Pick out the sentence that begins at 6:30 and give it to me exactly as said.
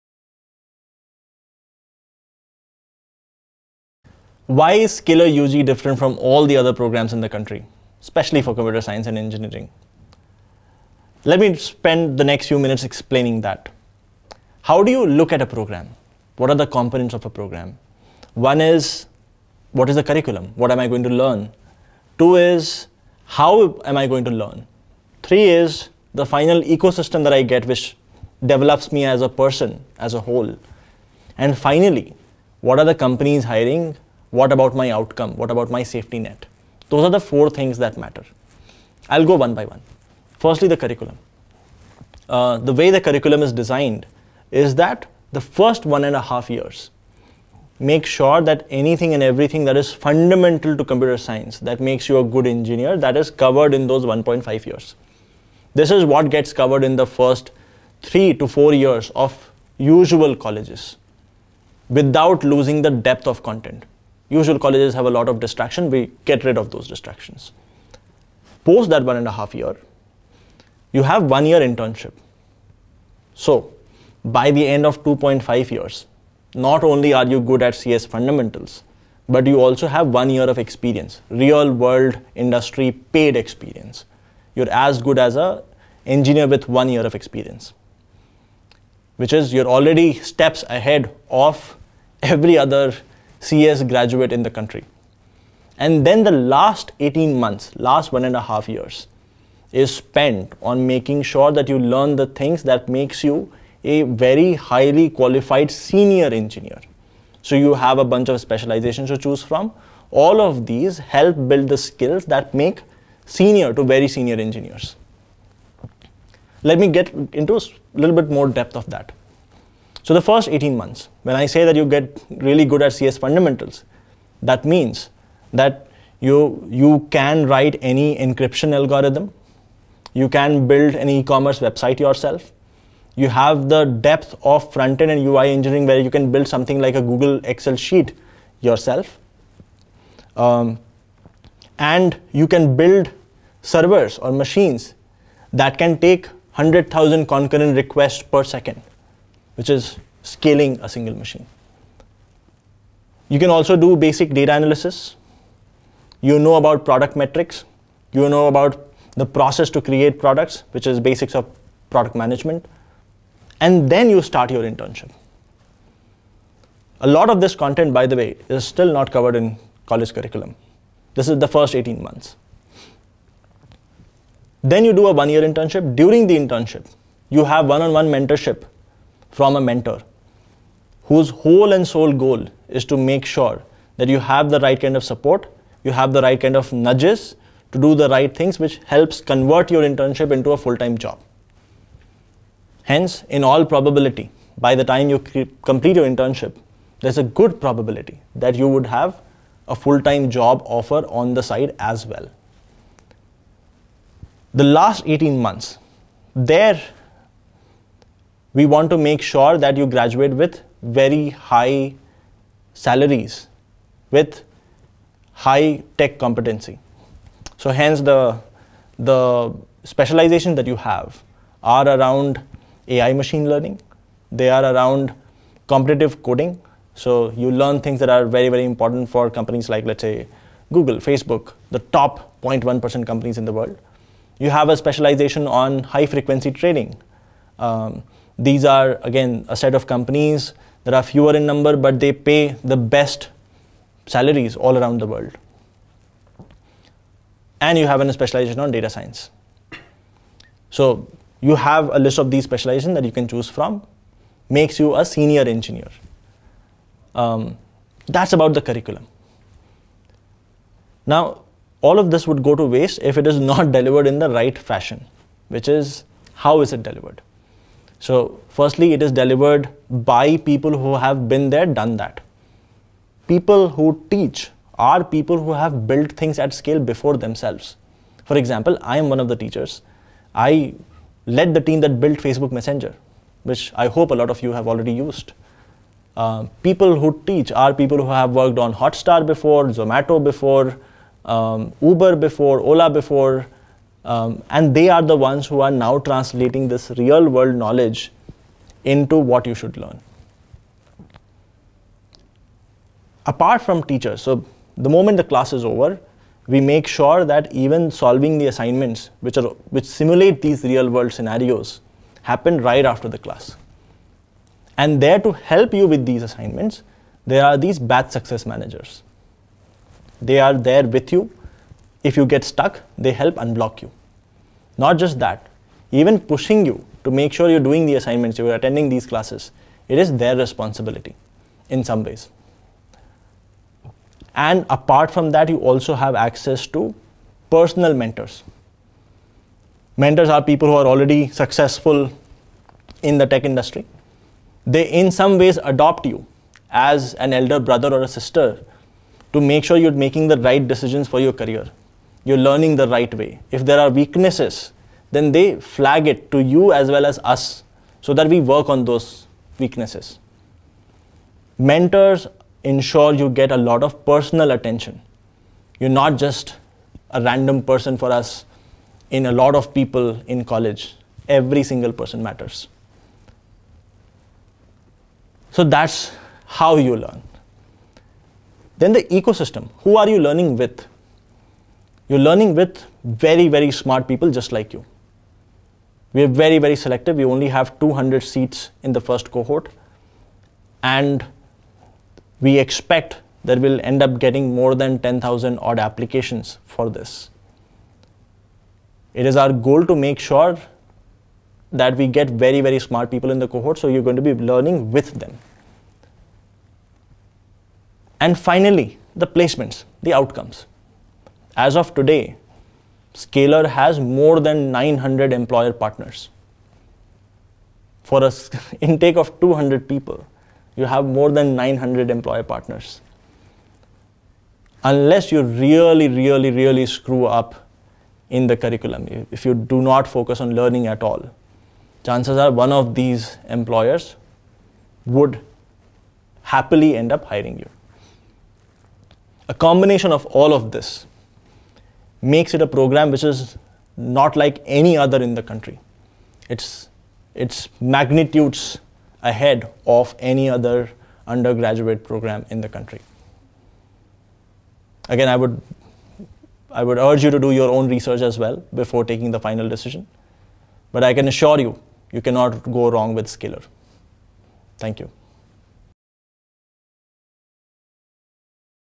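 And we expect that we'll end up getting more than 10,000 odd applications for this.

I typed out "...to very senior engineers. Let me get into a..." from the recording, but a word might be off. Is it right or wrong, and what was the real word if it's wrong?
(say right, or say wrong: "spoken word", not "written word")
right.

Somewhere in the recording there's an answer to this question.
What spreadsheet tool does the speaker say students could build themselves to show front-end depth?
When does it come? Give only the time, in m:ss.
2:17.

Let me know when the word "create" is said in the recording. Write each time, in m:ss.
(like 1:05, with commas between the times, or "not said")
2:39.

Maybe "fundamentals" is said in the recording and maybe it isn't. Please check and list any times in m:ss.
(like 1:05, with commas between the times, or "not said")
0:49, 1:18, 2:03.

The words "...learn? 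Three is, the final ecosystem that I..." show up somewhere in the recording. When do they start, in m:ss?
0:24.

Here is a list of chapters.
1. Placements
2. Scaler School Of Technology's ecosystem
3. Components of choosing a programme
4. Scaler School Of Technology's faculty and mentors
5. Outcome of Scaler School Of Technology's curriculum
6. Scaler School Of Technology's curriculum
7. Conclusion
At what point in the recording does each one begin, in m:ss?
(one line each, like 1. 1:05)
1. 6:51
2. 6:19
3. 0:17
4. 4:22
5. 2:00
6. 0:41
7. 7:20.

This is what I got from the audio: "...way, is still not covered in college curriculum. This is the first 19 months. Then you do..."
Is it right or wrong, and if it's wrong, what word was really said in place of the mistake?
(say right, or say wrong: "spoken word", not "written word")
wrong: "18", not "19".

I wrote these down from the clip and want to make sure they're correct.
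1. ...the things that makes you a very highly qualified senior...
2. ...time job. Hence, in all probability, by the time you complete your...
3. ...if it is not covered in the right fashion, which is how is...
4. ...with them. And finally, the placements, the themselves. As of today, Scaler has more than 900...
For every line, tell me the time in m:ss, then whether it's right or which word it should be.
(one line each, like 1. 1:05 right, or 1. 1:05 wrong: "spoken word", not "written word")
1. 1:42 right
2. 3:10 right
3. 4:23 wrong: "delivered", not "covered"
4. 6:44 wrong: "outcomes", not "themselves".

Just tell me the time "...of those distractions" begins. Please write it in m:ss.
1:06.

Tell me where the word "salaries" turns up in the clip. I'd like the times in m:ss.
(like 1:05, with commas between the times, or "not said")
3:32, 4:04.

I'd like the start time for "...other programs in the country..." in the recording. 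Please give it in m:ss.
0:06.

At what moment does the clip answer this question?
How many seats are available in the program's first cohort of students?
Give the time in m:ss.
6:27.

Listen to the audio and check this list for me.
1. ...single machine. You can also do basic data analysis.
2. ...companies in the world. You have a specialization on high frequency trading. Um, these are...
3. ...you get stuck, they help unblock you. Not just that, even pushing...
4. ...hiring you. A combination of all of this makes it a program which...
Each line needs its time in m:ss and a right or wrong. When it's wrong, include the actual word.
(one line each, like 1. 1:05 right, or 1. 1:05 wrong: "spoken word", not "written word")
1. 2:30 right
2. 3:53 right
3. 5:22 right
4. 7:17 right.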